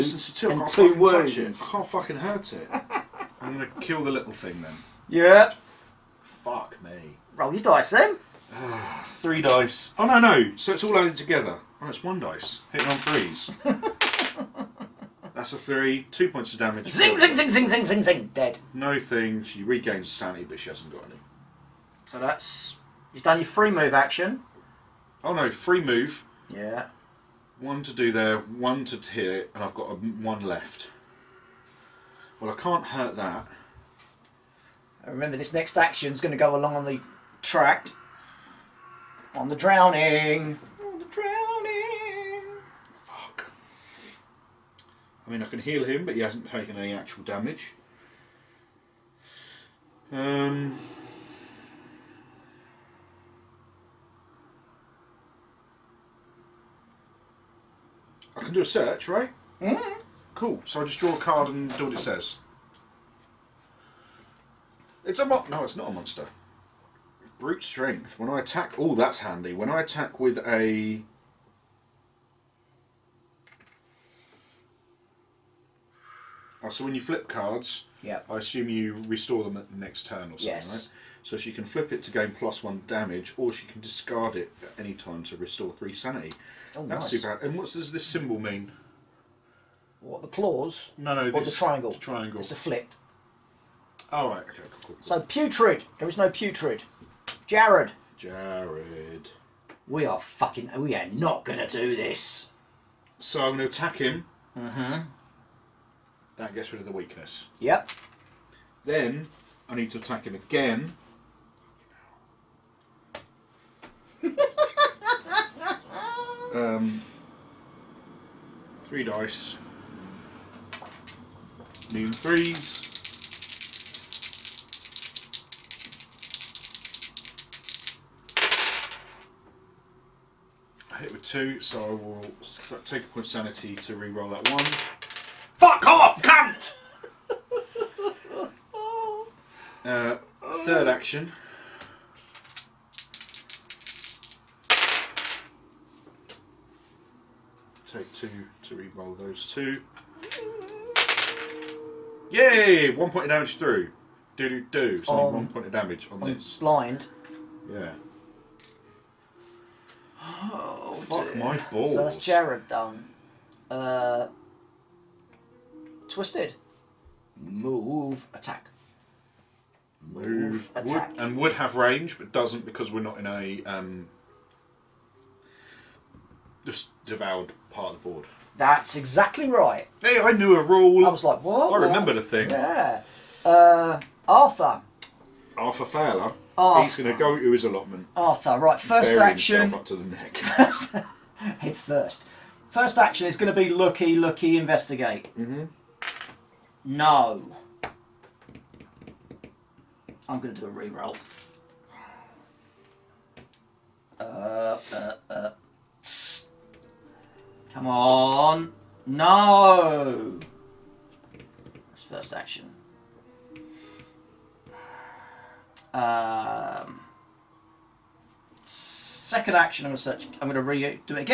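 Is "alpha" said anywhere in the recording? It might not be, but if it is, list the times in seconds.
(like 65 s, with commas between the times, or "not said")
not said.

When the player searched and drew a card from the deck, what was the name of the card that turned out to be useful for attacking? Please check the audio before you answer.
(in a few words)
Brute strength.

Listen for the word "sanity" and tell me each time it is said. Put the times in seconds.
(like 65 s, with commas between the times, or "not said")
20 s, 85 s, 133 s.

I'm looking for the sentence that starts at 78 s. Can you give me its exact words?
I assume you restore them at the next turn or something, yes.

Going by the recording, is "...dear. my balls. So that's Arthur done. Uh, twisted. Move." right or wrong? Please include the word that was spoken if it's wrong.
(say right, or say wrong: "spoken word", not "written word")
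wrong: "Jared", not "Arthur".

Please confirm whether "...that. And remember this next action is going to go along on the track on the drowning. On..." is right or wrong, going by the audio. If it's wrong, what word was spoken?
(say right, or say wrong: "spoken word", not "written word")
right.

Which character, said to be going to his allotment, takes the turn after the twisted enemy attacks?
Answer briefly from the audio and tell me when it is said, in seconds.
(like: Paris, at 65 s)
Arthur Fowler, at 185 s.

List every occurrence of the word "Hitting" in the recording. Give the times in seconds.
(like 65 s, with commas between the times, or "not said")
12 s.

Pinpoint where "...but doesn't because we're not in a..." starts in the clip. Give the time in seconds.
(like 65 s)
172 s.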